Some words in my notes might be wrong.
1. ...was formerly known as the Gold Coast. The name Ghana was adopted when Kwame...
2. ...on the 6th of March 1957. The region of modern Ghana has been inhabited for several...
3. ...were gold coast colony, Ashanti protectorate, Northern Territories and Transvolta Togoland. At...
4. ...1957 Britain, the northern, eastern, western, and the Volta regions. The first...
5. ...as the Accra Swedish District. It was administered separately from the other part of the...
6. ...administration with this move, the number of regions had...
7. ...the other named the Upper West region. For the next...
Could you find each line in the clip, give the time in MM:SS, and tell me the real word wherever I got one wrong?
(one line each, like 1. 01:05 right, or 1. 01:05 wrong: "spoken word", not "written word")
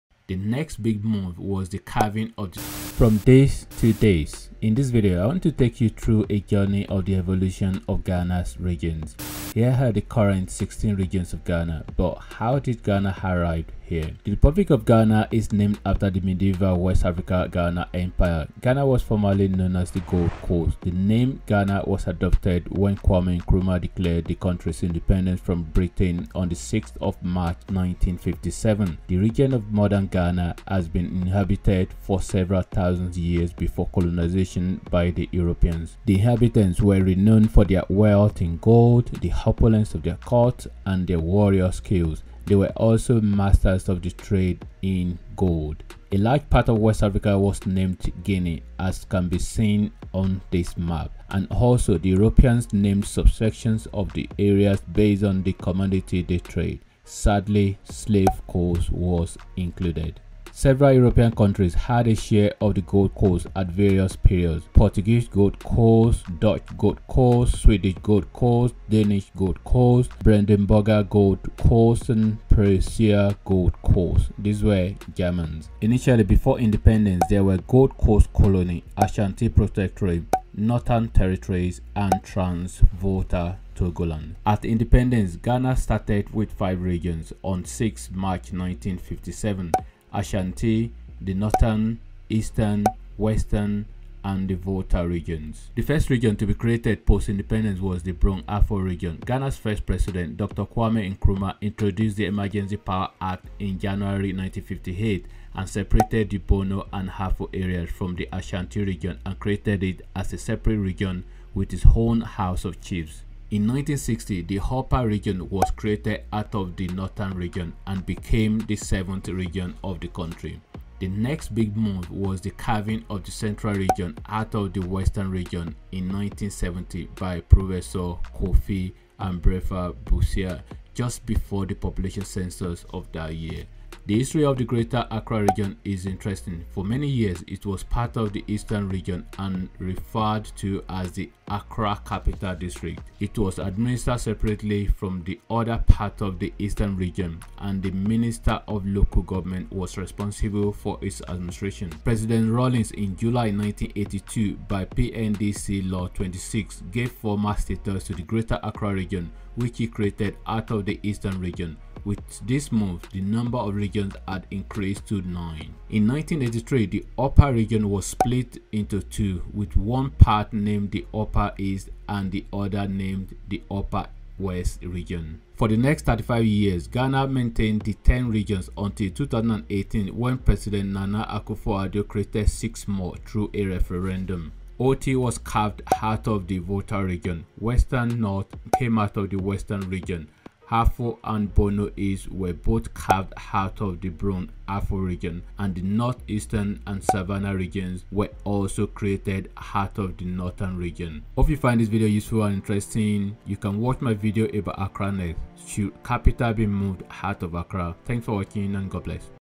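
1. 00:18 right
2. 00:26 right
3. 01:17 right
4. 01:28 wrong: "Ashanti", not "Britain"
5. 02:20 wrong: "Capital", not "Swedish"
6. 02:41 wrong: "region", not "administration"
7. 02:52 right.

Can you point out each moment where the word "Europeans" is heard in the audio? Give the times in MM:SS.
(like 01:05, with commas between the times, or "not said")
00:35, 00:52, 01:00.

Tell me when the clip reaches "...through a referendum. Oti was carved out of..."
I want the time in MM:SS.
03:03.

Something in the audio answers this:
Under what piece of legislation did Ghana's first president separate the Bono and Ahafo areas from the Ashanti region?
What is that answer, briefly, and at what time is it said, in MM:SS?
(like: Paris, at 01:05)
Emergency Power Act, at 01:42.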